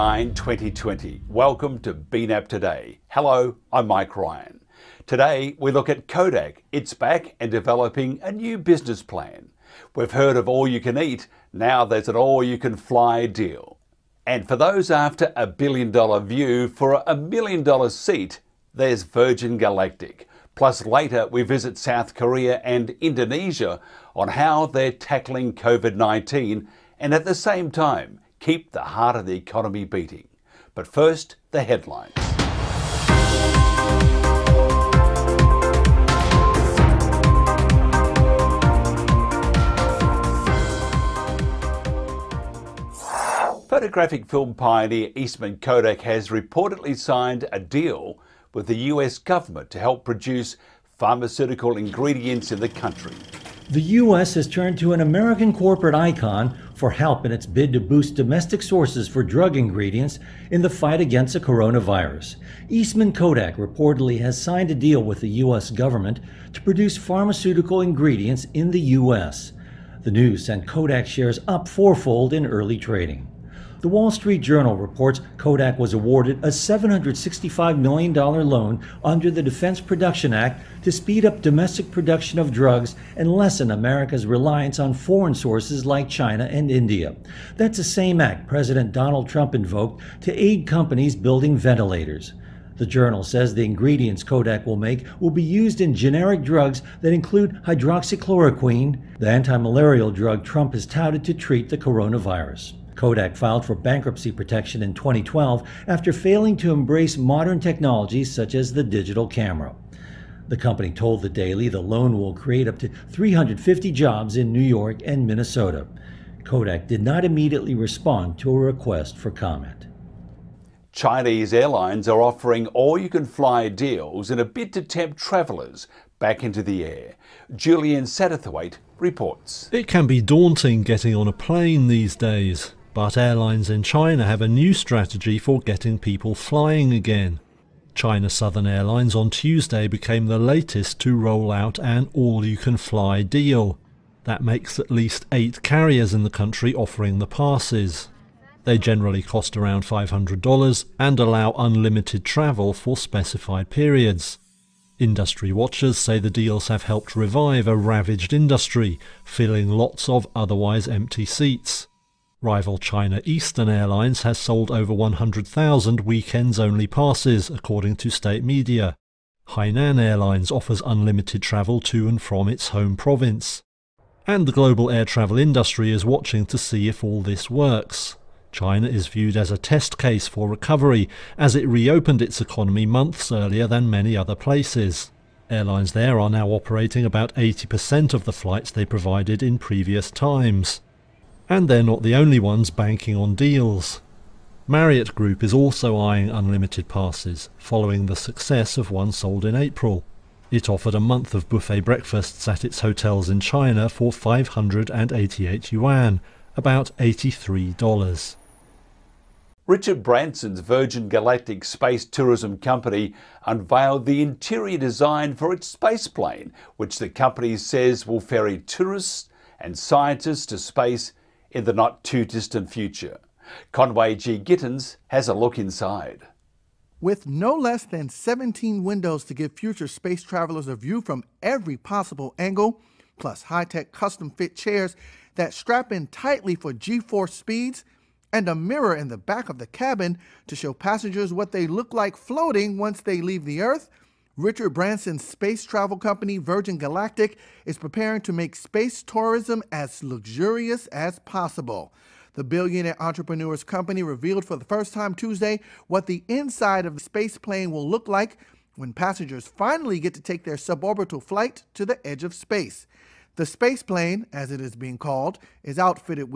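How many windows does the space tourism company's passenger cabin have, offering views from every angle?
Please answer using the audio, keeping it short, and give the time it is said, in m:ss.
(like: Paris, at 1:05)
17, at 3:48.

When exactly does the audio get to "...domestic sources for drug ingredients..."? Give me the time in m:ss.
0:58.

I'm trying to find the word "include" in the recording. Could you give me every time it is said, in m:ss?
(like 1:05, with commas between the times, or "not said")
1:37.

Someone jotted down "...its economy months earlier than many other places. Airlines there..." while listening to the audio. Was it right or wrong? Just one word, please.
right.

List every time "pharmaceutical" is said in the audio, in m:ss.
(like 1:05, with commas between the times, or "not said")
0:50, 1:06.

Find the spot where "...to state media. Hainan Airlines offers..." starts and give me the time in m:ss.
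2:47.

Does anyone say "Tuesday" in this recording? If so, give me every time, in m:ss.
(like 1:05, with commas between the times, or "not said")
2:19, 4:15.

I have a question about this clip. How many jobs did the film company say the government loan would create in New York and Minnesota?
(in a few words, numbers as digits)
350.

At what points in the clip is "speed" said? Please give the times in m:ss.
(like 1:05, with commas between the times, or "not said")
1:20, 3:57.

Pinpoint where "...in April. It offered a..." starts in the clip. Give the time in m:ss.
3:19.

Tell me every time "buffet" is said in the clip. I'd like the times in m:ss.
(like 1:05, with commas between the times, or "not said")
3:21.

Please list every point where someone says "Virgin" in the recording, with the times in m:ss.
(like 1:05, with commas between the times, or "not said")
0:19, 3:30, 4:06.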